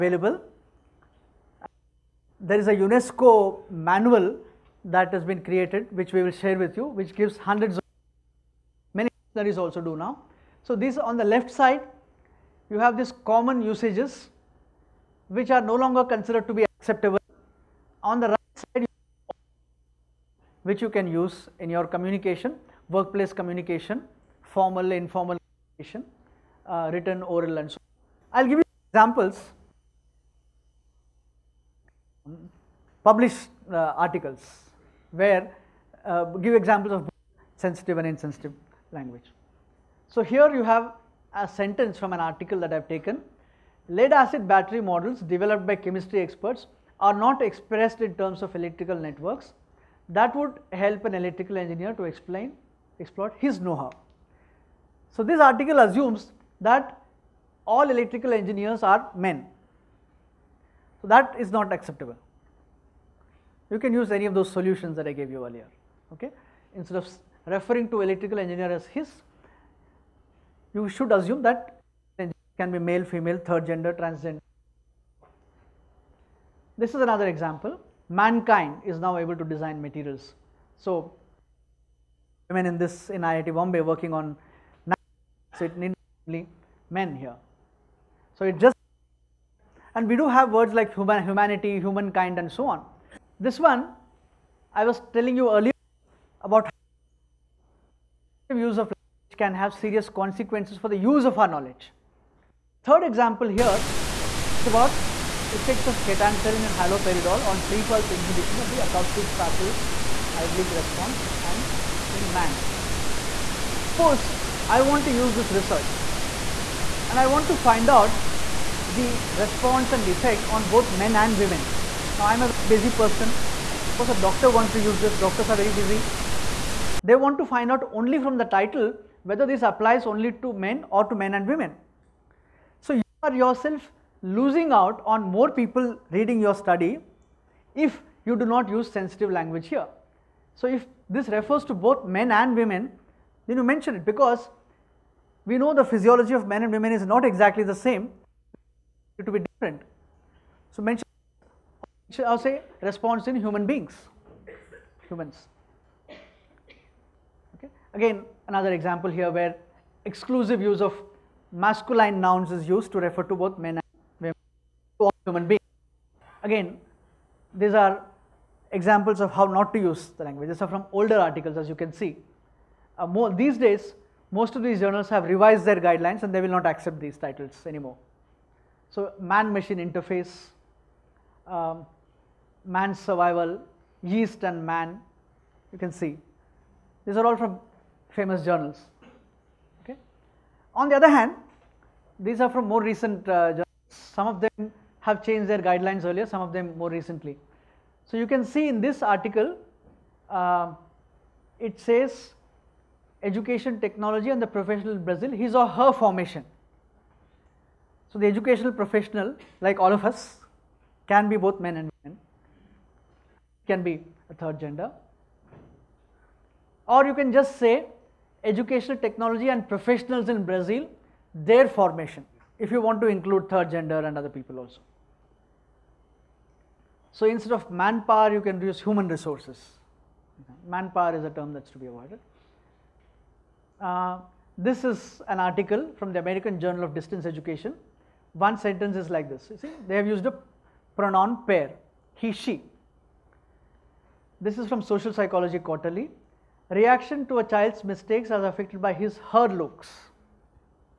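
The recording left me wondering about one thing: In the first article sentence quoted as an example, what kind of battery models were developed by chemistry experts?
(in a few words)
Lead acid.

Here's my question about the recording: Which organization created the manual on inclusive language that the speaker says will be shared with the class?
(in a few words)
UNESCO.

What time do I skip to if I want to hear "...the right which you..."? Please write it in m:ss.
0:18.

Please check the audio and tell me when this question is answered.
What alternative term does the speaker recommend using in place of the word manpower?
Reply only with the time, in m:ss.
3:48.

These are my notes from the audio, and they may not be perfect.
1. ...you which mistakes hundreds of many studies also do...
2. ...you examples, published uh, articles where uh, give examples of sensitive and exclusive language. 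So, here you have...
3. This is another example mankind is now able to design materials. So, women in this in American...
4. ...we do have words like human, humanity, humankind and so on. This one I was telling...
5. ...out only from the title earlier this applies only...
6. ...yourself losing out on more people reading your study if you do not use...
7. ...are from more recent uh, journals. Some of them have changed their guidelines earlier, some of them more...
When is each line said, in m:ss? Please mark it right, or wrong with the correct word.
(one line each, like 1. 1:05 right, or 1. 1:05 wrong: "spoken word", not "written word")
1. 0:06 wrong: "gives", not "mistakes"
2. 0:28 wrong: "insensitive", not "exclusive"
3. 1:16 wrong: "IIT", not "American"
4. 1:30 right
5. 2:07 wrong: "whether", not "earlier"
6. 2:13 right
7. 3:12 right.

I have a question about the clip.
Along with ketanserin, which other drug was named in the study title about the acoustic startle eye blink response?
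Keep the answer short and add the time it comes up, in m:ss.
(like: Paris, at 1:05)
Haloperidol, at 1:46.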